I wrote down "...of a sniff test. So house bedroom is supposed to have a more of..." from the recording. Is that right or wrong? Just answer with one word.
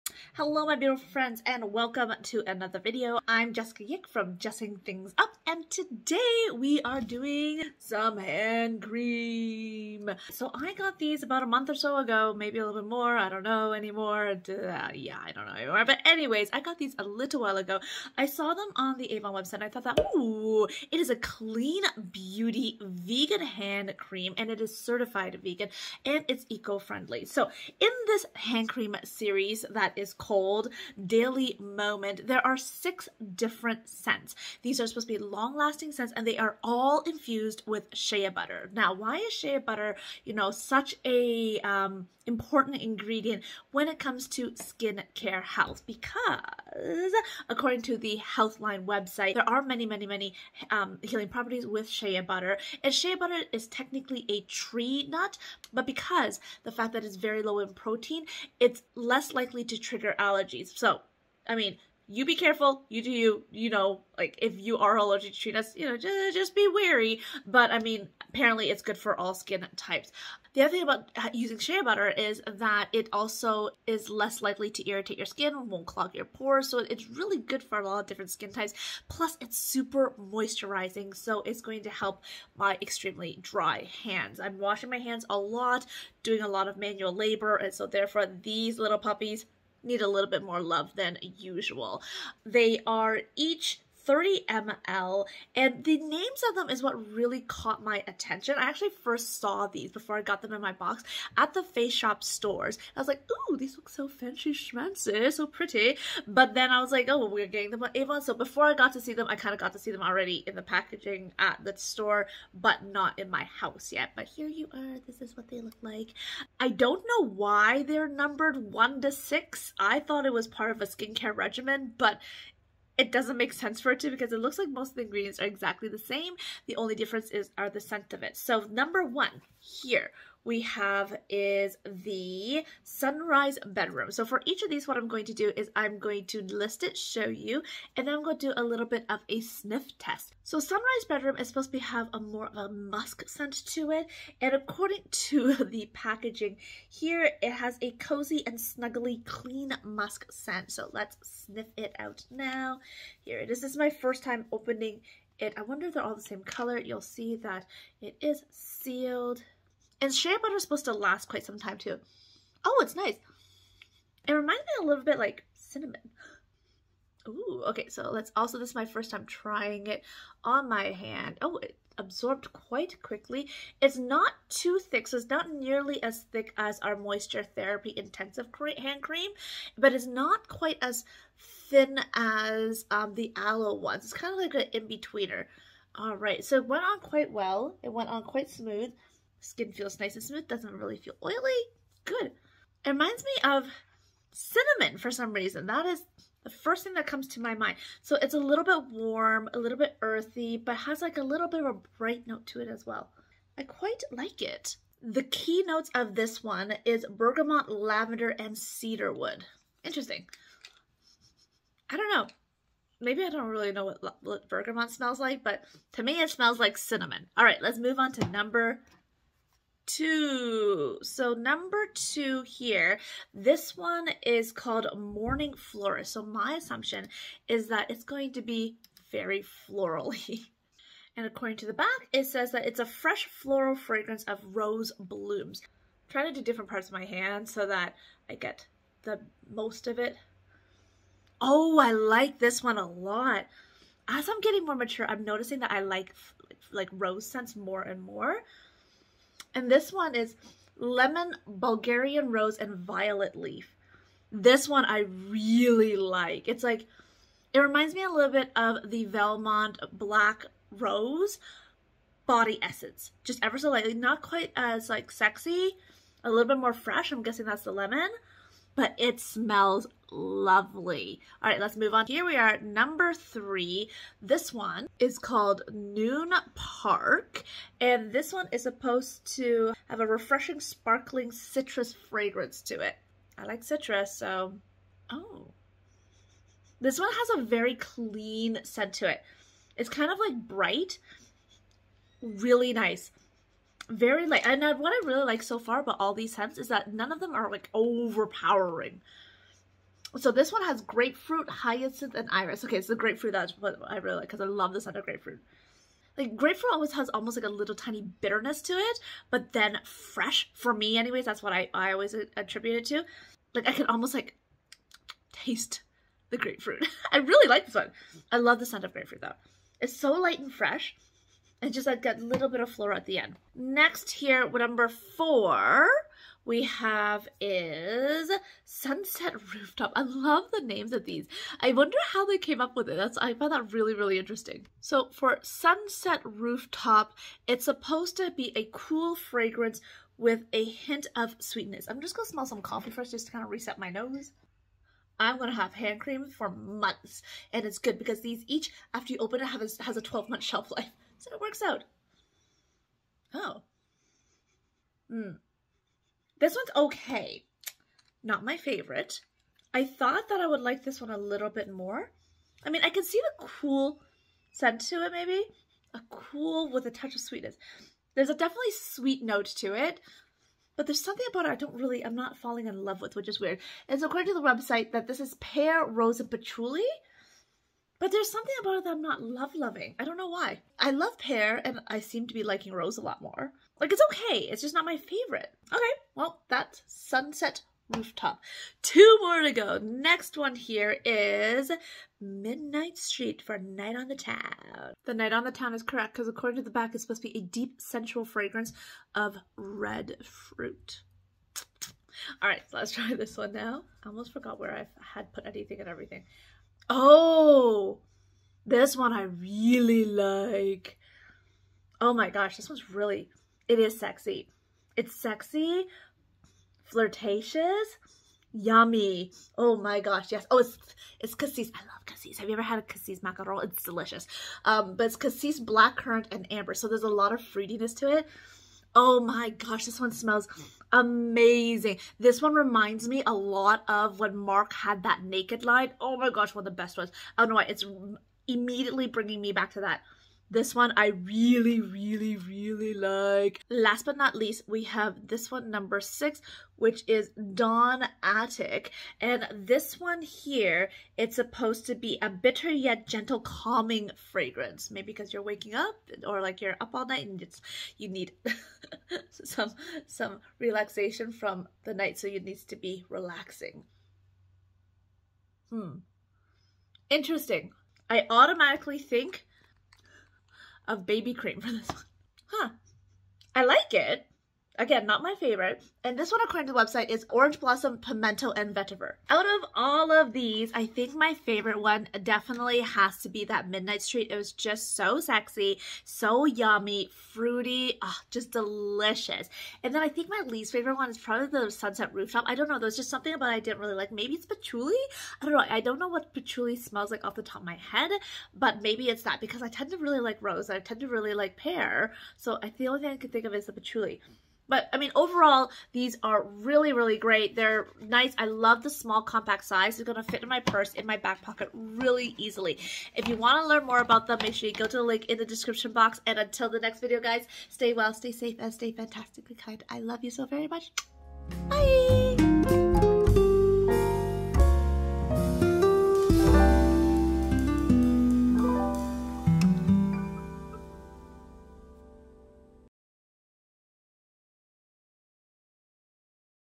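wrong.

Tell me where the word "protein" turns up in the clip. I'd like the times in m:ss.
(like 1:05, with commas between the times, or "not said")
0:57.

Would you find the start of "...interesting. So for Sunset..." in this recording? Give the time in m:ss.
5:34.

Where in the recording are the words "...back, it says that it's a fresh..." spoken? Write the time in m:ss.
3:51.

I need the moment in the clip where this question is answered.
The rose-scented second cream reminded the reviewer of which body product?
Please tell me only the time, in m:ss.
4:19.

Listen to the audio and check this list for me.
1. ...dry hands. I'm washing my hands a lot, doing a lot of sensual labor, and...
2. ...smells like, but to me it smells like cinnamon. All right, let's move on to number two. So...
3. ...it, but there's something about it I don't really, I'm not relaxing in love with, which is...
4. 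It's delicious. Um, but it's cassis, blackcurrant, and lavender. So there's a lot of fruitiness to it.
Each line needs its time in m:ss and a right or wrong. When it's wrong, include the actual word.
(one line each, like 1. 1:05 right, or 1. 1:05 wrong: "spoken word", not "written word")
1. 1:23 wrong: "manual", not "sensual"
2. 3:34 right
3. 6:09 wrong: "falling", not "relaxing"
4. 7:03 wrong: "amber", not "lavender".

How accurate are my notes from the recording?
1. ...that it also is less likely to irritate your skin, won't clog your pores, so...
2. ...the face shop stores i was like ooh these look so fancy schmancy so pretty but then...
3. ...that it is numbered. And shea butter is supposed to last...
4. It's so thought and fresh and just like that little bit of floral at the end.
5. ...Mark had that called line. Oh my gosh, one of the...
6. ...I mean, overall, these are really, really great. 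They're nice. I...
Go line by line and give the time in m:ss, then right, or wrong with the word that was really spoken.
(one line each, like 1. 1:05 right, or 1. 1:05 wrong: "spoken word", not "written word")
1. 1:12 right
2. 1:41 right
3. 2:37 wrong: "sealed", not "numbered"
4. 5:19 wrong: "light", not "thought"
5. 7:14 wrong: "naked", not "called"
6. 8:24 right.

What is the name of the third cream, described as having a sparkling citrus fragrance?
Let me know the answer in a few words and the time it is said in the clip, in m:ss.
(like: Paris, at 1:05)
Noon Park, at 4:35.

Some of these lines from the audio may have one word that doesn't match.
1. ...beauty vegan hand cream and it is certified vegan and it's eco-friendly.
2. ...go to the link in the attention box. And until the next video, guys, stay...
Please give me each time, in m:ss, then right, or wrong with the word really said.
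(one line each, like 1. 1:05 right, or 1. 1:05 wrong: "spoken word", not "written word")
1. 0:22 right
2. 8:34 wrong: "description", not "attention".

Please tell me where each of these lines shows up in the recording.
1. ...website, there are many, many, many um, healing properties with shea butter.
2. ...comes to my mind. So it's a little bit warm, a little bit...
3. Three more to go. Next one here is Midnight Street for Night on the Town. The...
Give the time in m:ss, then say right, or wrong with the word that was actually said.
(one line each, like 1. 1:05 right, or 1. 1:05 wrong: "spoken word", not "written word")
1. 0:48 right
2. 3:17 right
3. 6:28 wrong: "Two", not "Three".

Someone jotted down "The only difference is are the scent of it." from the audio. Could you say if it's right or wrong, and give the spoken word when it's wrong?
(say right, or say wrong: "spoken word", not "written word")
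right.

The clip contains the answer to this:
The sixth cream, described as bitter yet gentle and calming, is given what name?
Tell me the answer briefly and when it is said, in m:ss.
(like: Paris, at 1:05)
Dawn Attic, at 7:27.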